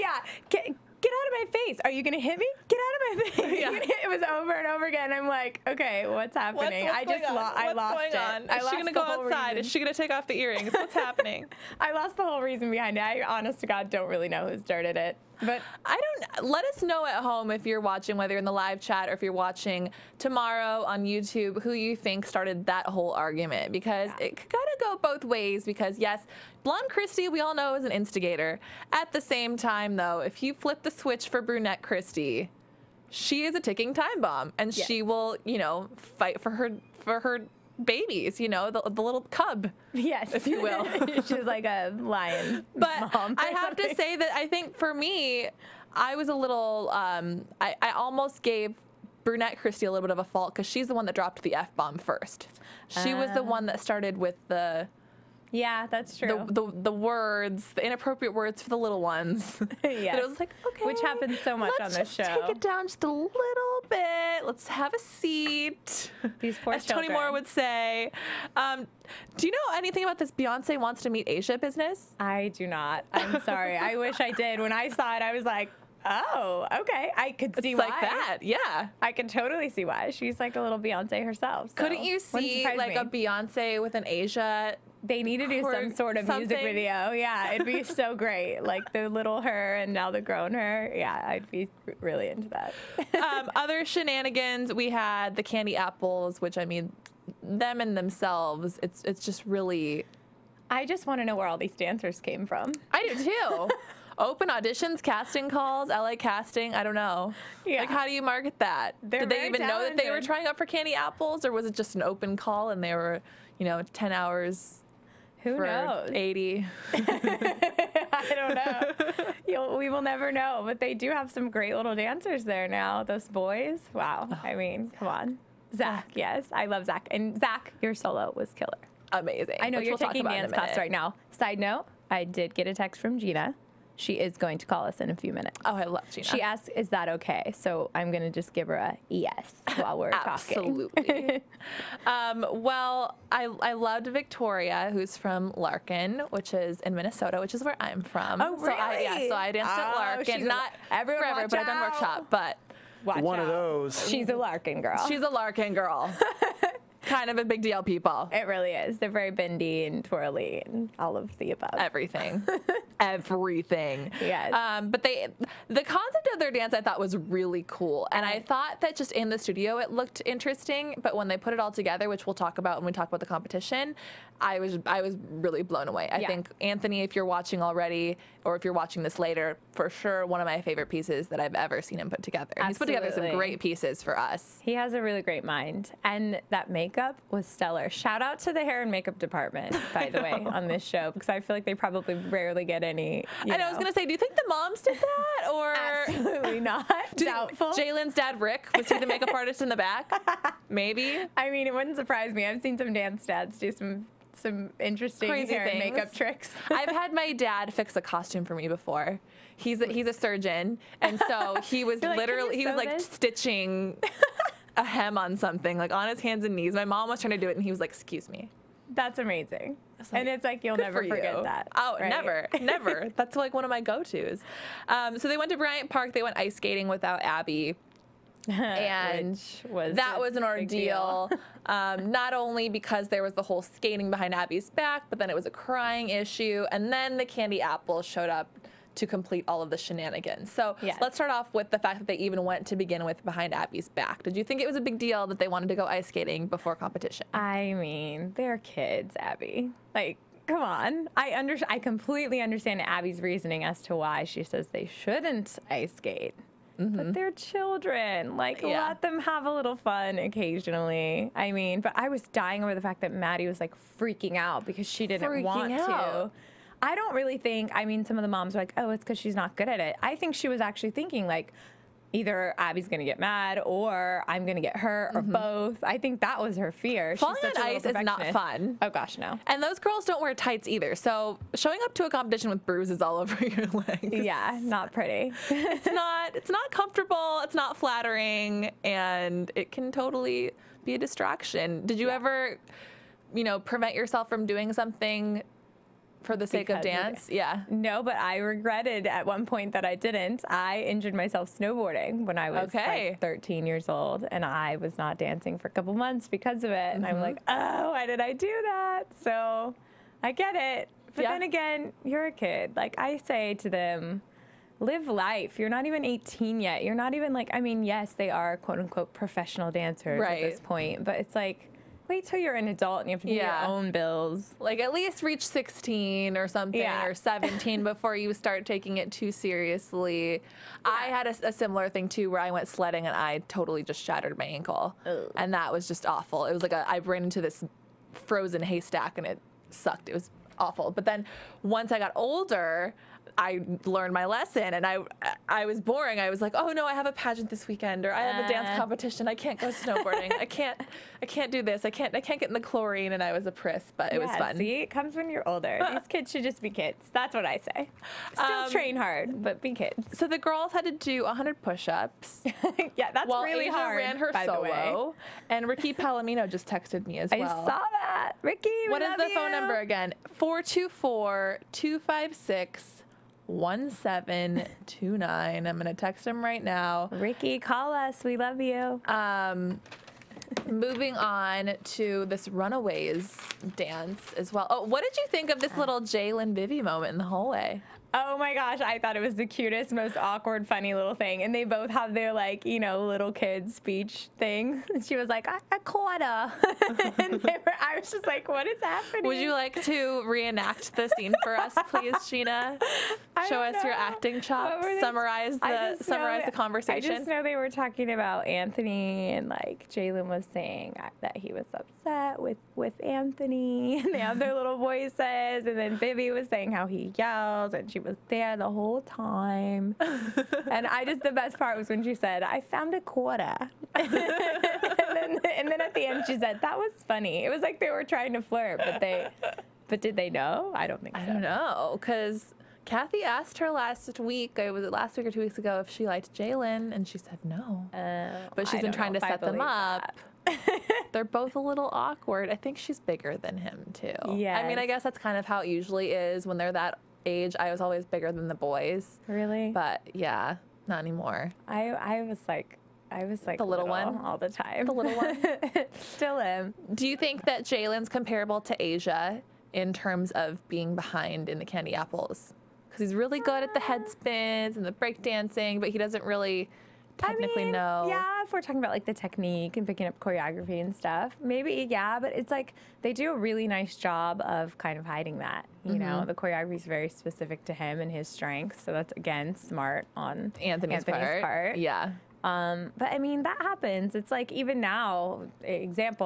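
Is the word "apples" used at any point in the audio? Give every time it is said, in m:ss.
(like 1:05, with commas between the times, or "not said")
1:35, 1:50, 3:57, 7:41.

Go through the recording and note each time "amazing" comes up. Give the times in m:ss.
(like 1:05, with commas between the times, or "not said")
2:09, 3:39.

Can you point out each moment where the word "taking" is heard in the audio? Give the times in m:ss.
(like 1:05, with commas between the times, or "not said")
2:10, 5:28.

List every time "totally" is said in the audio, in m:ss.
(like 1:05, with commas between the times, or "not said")
1:19, 4:49, 5:33.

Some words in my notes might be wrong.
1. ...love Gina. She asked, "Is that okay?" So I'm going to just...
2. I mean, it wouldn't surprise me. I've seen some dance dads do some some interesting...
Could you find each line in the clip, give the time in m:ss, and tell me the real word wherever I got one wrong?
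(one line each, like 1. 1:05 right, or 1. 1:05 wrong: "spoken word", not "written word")
1. 2:15 right
2. 3:21 right.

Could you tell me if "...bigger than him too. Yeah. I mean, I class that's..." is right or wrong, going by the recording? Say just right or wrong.
wrong.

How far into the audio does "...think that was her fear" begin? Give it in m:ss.
4:35.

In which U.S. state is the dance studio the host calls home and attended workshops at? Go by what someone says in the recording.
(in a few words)
Minnesota.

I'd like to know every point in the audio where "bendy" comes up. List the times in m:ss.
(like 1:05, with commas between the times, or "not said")
2:39.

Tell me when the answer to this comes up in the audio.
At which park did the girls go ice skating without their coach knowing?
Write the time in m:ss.
3:45.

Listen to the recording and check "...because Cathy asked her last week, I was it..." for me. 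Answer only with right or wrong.
right.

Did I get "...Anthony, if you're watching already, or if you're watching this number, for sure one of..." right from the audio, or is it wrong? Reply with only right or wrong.
wrong.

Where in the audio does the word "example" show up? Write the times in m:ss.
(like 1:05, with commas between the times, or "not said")
8:05.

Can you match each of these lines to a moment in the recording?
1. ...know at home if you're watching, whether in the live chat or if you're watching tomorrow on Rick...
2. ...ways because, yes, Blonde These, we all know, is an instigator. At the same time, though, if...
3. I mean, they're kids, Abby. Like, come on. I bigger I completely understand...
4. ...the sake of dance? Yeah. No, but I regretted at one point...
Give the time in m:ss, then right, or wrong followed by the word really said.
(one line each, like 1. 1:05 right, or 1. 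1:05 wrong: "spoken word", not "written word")
1. 0:16 wrong: "YouTube", not "Rick"
2. 0:25 wrong: "Christie", not "These"
3. 4:07 wrong: "under", not "bigger"
4. 4:56 right.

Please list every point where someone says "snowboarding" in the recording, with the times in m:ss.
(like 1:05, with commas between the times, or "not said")
5:01, 5:49.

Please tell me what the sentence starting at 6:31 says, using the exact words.
And they both have their like, you know, little kid speech thing.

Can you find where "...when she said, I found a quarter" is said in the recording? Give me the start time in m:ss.
7:01.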